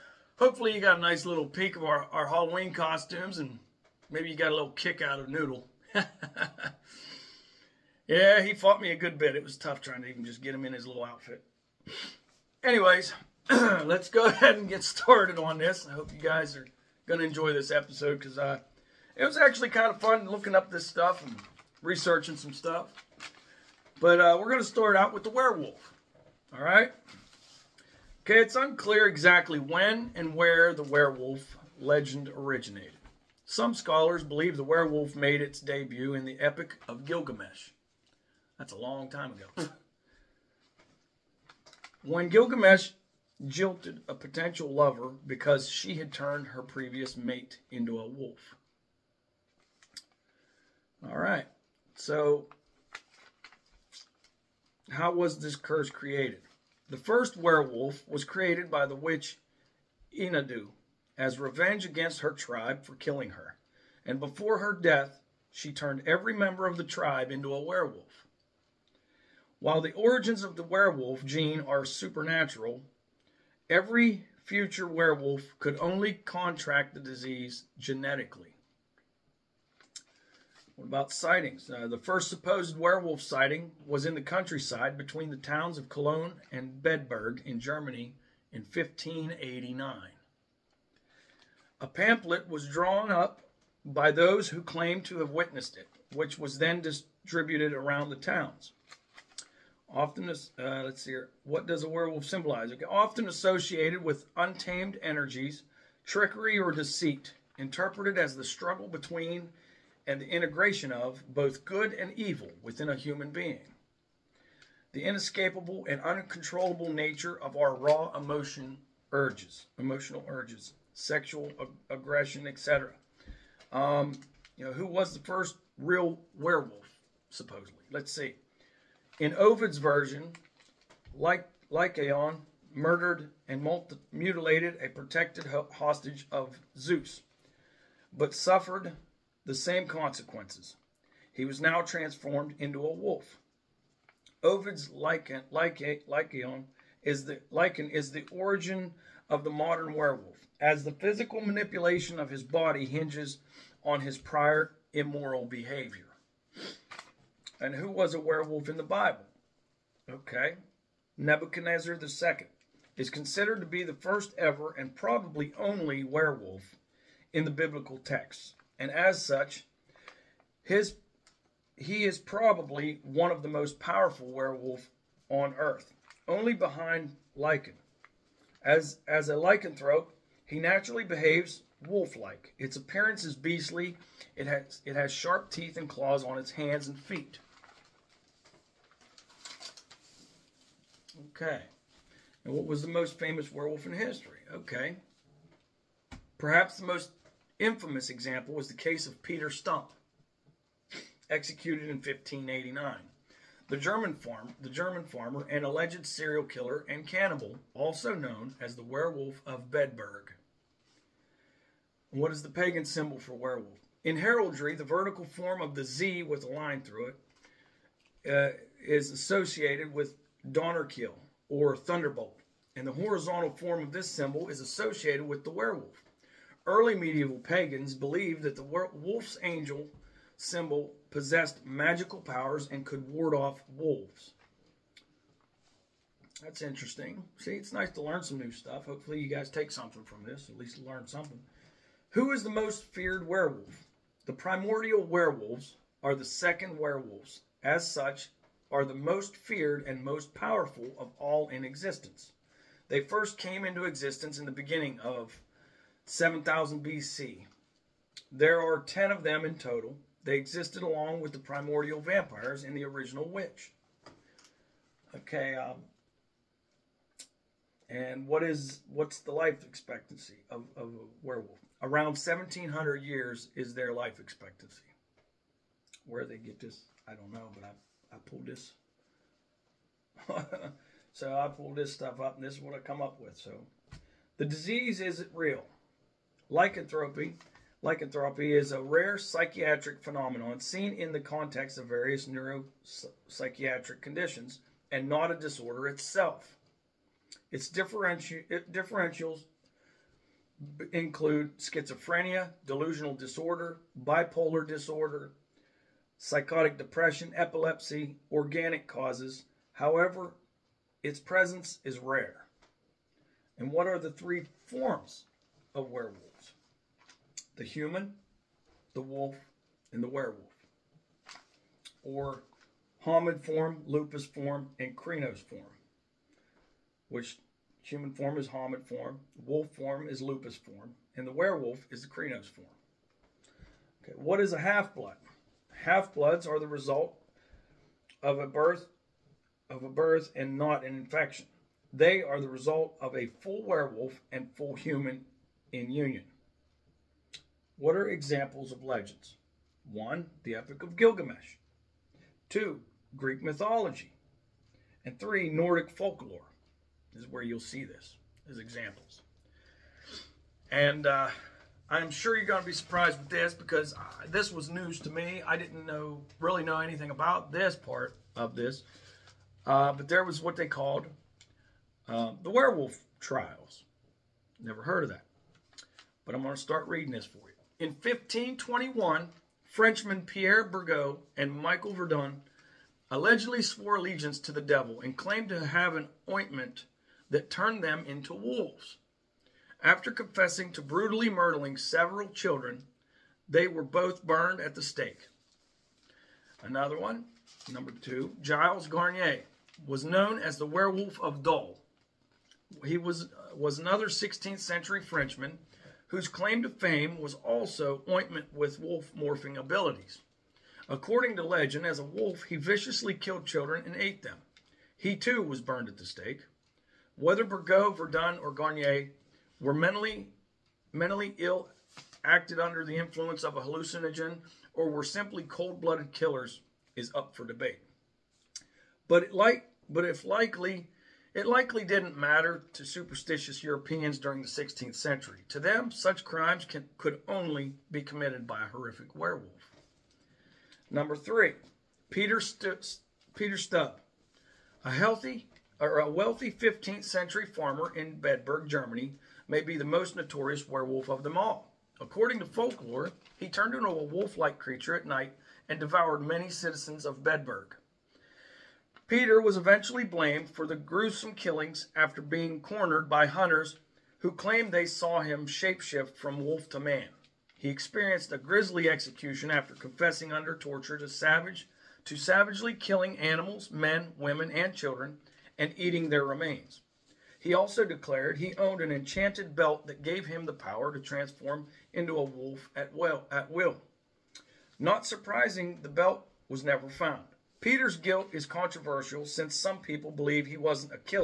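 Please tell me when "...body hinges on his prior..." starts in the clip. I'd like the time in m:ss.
2:32.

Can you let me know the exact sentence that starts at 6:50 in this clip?
According to legend, as a wolf, he viciously killed children and ate them.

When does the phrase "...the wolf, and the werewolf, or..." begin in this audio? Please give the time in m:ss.
5:18.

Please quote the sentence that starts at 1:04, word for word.
And before her death, she turned every member of the tribe into a werewolf.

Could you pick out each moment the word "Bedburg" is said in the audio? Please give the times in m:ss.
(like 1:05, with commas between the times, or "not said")
1:26, 3:29, 7:28, 7:37.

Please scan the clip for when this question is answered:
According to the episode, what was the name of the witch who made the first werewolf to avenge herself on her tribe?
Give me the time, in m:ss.
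1:00.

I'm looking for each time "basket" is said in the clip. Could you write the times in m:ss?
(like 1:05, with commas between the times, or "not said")
not said.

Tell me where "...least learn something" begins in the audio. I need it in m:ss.
4:00.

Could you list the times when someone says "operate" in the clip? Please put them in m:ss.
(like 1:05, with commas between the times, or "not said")
not said.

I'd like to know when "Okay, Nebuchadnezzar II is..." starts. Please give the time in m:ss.
2:40.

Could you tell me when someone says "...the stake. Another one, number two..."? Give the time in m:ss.
6:34.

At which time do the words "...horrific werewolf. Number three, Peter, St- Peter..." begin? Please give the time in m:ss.
7:18.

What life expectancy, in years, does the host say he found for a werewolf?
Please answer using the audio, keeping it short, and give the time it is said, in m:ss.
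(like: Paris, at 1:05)
1,700 years, at 4:32.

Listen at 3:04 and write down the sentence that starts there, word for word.
It has, it has sharp teeth and claws on its hands and feet.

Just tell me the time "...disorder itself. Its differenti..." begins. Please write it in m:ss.
4:55.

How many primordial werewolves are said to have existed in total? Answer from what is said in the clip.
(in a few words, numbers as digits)
10.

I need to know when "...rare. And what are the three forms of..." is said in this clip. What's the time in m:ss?
5:11.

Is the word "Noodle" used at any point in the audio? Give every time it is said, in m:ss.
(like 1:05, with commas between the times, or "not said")
0:05.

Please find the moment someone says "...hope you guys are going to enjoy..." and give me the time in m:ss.
0:15.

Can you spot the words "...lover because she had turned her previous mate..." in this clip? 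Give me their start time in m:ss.
0:44.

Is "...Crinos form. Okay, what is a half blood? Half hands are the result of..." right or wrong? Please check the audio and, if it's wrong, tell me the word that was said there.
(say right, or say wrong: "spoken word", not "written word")
wrong: "bloods", not "hands".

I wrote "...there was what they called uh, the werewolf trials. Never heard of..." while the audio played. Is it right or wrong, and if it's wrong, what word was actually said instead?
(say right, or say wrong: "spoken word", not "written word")
right.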